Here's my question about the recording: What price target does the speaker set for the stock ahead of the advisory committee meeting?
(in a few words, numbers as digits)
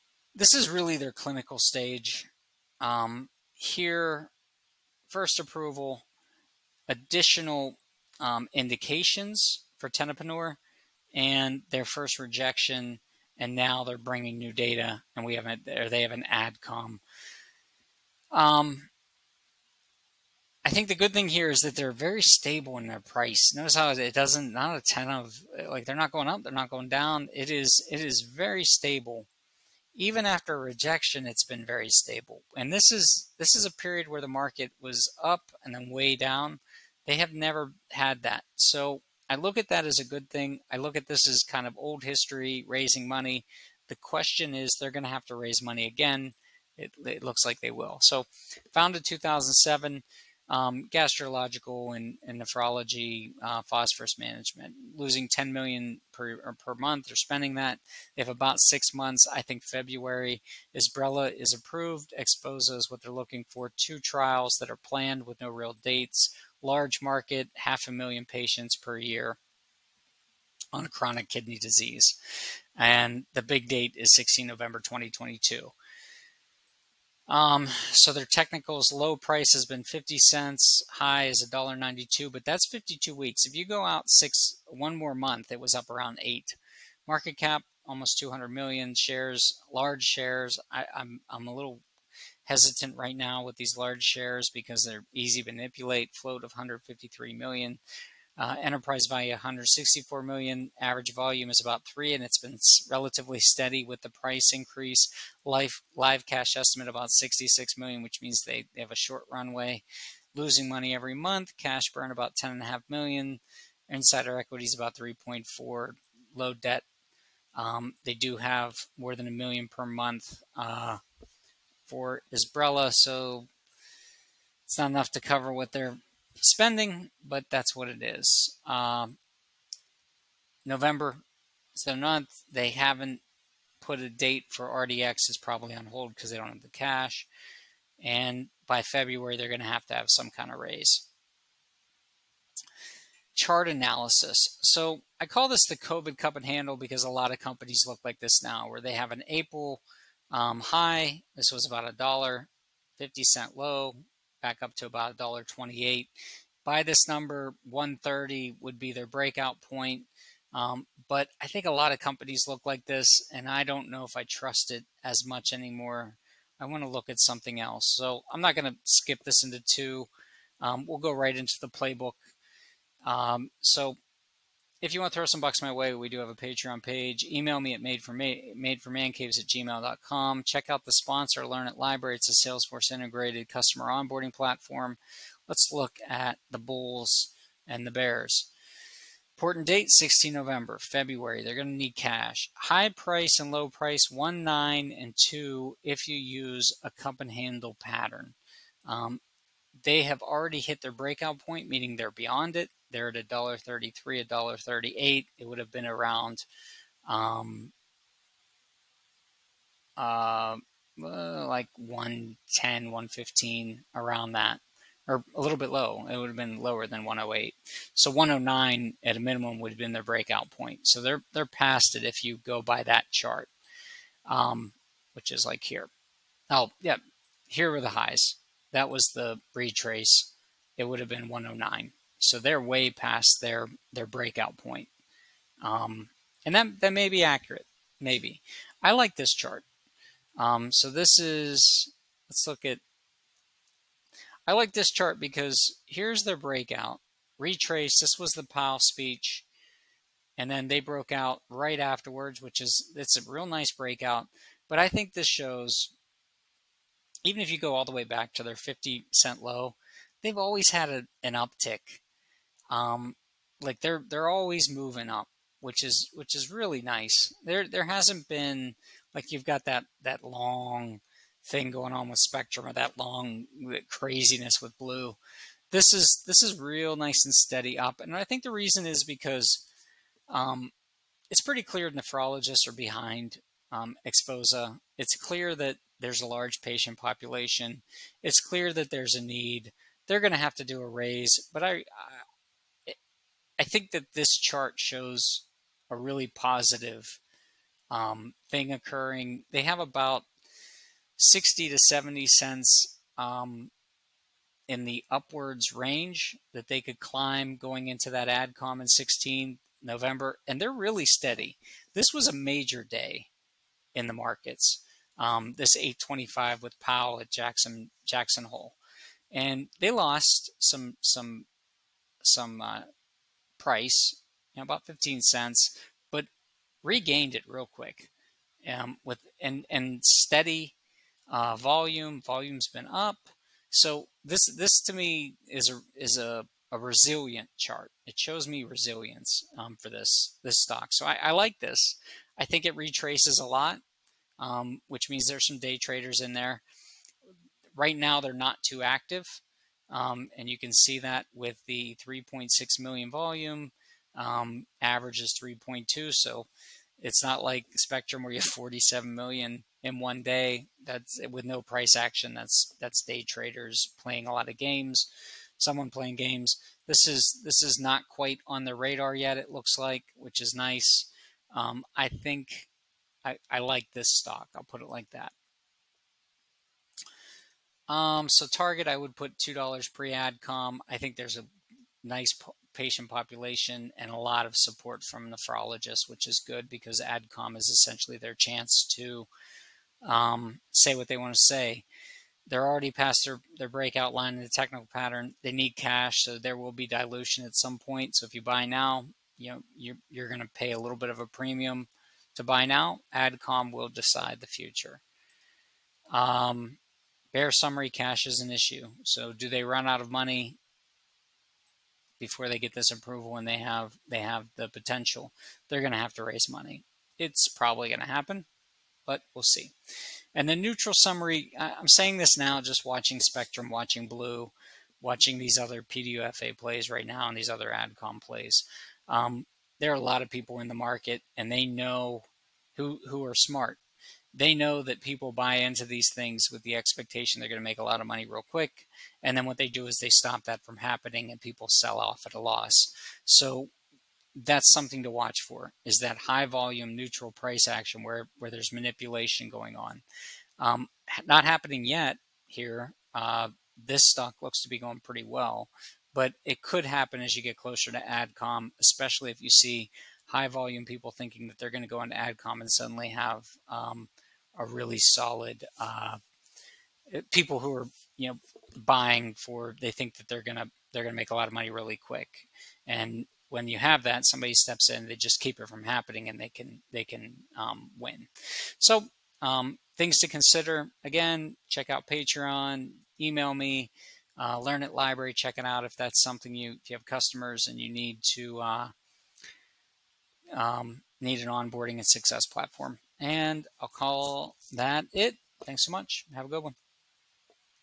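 $2.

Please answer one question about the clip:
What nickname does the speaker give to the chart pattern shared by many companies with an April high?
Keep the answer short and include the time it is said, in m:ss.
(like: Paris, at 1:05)
COVID cup and handle, at 2:25.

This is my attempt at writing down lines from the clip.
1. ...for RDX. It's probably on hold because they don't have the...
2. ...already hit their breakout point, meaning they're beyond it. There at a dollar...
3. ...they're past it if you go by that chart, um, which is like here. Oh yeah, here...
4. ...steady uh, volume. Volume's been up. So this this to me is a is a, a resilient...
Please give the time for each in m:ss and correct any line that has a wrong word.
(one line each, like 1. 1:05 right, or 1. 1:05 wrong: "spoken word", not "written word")
1. 2:14 right
2. 3:20 right
3. 3:41 right
4. 5:30 right.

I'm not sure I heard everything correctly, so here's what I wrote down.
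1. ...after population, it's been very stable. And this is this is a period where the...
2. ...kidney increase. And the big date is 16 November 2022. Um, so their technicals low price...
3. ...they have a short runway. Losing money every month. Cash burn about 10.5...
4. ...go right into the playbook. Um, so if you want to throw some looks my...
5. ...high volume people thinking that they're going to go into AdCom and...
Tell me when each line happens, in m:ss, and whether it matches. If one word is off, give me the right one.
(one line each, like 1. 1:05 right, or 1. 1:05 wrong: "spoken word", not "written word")
1. 0:30 wrong: "rejection", not "population"
2. 1:11 wrong: "disease", not "increase"
3. 1:48 right
4. 2:50 wrong: "bucks", not "looks"
5. 7:40 right.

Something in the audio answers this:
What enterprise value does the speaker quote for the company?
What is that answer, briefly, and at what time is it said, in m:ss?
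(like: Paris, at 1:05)
164 million, at 1:38.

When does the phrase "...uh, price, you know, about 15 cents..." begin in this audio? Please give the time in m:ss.
5:22.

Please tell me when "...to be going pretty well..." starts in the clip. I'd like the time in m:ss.
7:34.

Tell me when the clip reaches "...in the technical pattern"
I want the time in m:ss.
6:34.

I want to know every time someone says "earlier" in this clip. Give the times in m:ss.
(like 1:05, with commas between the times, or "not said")
not said.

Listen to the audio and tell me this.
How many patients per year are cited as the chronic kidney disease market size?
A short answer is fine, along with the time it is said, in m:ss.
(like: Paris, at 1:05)
half a million, at 1:07.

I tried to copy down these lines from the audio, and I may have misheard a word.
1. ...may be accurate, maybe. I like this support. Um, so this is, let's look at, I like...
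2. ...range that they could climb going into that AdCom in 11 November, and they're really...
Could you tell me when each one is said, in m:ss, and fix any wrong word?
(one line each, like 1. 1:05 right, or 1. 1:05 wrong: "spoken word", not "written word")
1. 3:56 wrong: "chart", not "support"
2. 5:05 wrong: "16", not "11".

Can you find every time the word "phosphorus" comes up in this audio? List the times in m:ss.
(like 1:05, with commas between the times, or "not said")
0:53.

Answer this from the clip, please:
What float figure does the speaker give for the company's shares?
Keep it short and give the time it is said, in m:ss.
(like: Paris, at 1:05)
153 million, at 1:36.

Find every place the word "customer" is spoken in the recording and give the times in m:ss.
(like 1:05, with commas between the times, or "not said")
3:03, 8:07.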